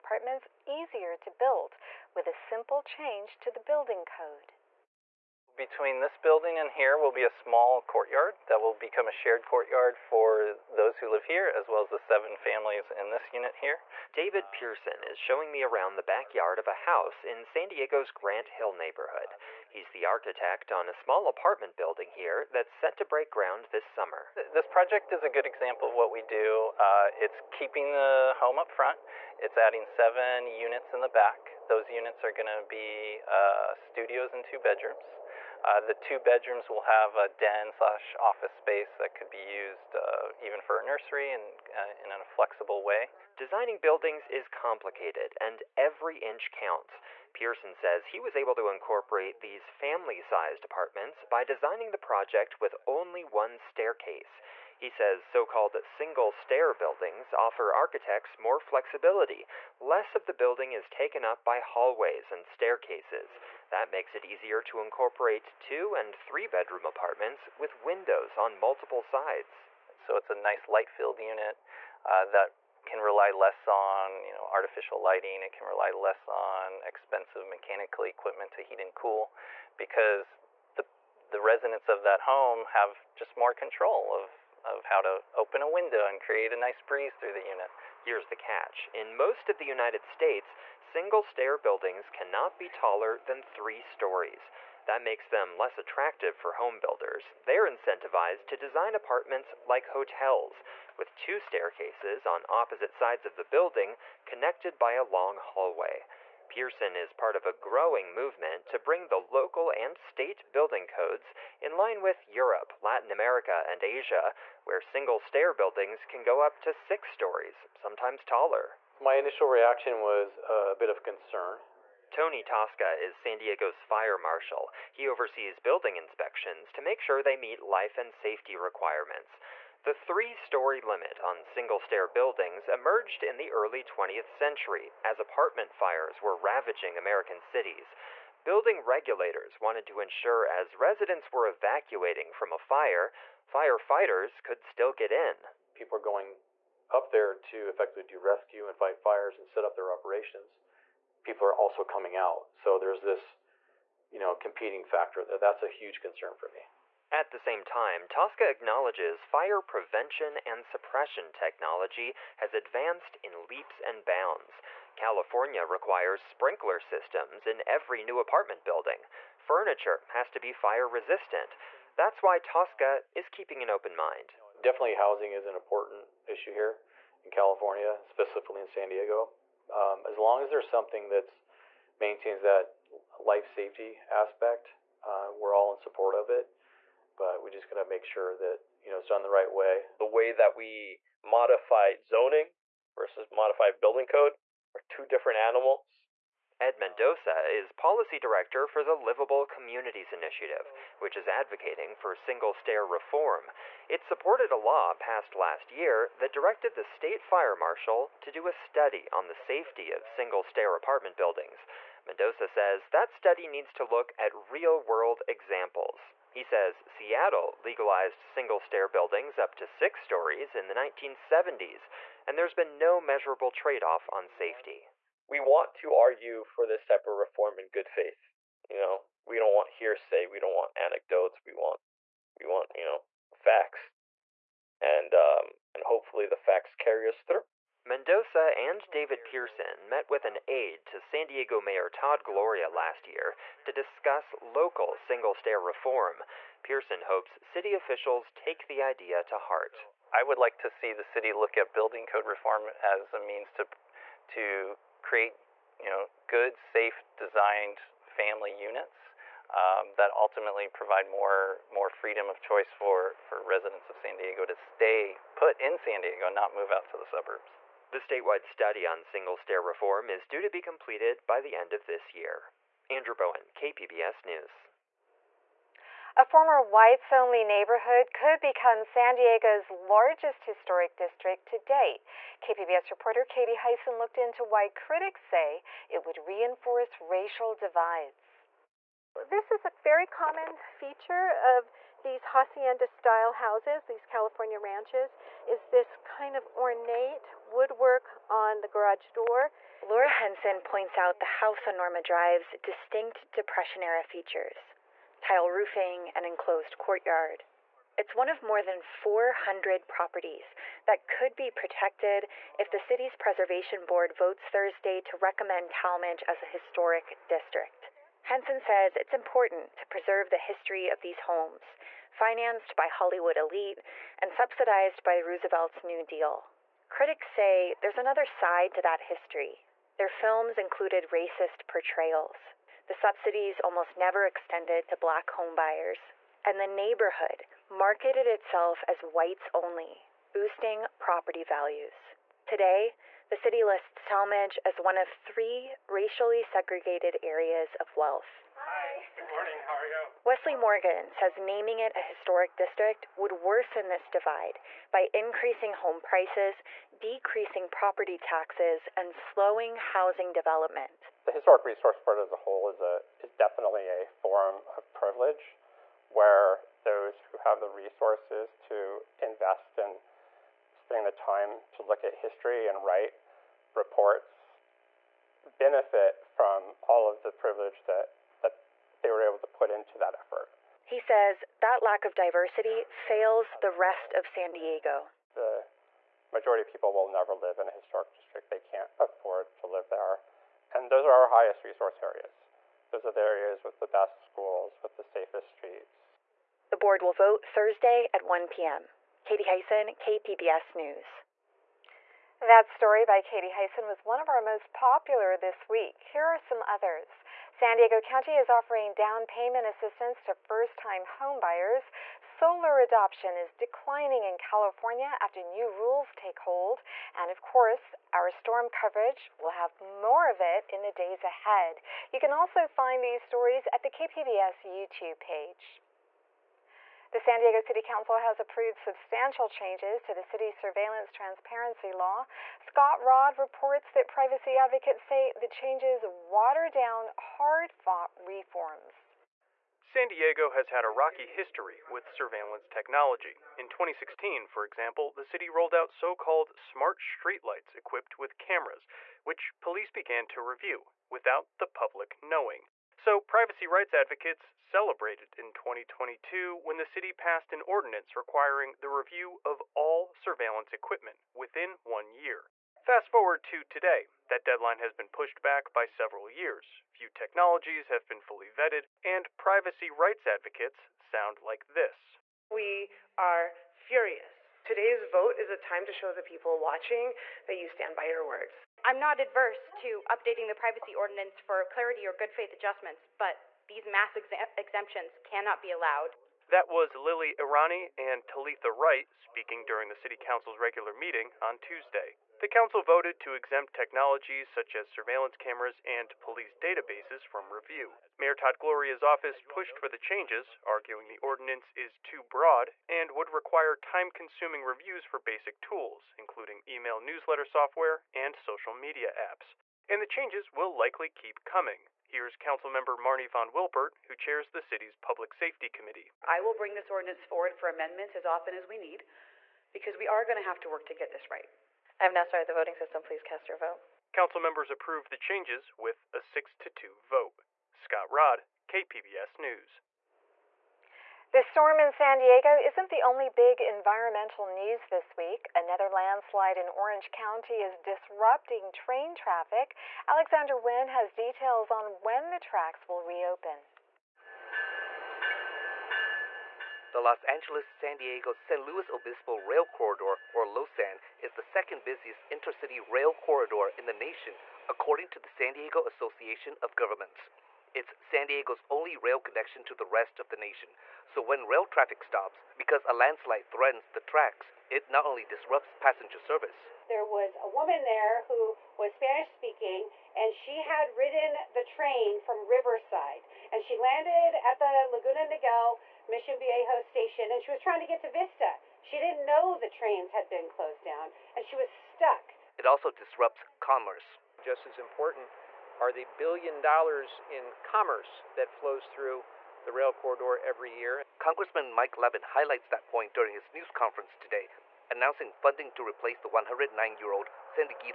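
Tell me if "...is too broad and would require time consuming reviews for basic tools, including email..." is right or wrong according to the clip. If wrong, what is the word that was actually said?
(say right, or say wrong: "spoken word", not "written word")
right.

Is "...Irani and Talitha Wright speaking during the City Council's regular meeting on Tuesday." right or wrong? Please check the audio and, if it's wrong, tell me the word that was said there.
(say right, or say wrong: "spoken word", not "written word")
right.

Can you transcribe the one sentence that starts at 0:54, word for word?
He says so called single stair buildings offer architects more flexibility.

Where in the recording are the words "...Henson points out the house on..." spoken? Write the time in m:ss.
5:00.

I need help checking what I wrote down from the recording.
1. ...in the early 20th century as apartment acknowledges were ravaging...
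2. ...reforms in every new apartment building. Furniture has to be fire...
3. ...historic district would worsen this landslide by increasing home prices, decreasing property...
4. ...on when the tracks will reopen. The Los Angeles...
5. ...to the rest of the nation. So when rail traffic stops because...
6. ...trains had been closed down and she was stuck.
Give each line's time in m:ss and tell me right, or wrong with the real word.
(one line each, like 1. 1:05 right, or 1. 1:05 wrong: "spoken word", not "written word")
1. 2:13 wrong: "fires", not "acknowledges"
2. 2:46 wrong: "systems", not "reforms"
3. 5:52 wrong: "divide", not "landslide"
4. 9:01 right
5. 9:19 right
6. 9:39 right.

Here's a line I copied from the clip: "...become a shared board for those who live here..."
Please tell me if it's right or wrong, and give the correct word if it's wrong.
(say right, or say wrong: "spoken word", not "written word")
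wrong: "courtyard", not "board".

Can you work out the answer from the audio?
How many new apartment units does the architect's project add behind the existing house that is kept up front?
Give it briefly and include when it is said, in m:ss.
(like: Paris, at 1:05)
7, at 0:29.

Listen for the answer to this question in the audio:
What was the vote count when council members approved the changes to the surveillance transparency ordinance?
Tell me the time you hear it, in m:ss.
8:46.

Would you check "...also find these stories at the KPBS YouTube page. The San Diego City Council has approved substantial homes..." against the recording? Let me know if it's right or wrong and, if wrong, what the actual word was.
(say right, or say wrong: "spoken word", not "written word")
wrong: "changes", not "homes".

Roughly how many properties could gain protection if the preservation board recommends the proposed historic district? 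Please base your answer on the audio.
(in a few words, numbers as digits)
400.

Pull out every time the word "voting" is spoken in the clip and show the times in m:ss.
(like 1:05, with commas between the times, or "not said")
8:42.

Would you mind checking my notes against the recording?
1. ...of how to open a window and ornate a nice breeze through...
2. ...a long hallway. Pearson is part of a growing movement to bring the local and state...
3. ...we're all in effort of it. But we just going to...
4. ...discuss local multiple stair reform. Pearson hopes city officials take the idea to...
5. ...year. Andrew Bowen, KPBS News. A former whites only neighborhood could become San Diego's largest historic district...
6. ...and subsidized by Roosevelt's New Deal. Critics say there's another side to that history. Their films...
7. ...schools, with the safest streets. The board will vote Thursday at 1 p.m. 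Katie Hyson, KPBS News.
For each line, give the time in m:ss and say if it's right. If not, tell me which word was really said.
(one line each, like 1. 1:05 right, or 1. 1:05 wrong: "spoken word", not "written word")
1. 1:24 wrong: "create", not "ornate"
2. 1:44 right
3. 3:05 wrong: "support", not "effort"
4. 4:03 wrong: "single", not "multiple"
5. 4:32 right
6. 5:24 right
7. 6:34 right.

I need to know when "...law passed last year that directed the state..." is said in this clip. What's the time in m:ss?
3:24.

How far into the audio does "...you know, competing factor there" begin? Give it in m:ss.
2:34.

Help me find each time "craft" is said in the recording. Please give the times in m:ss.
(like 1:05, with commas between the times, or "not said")
not said.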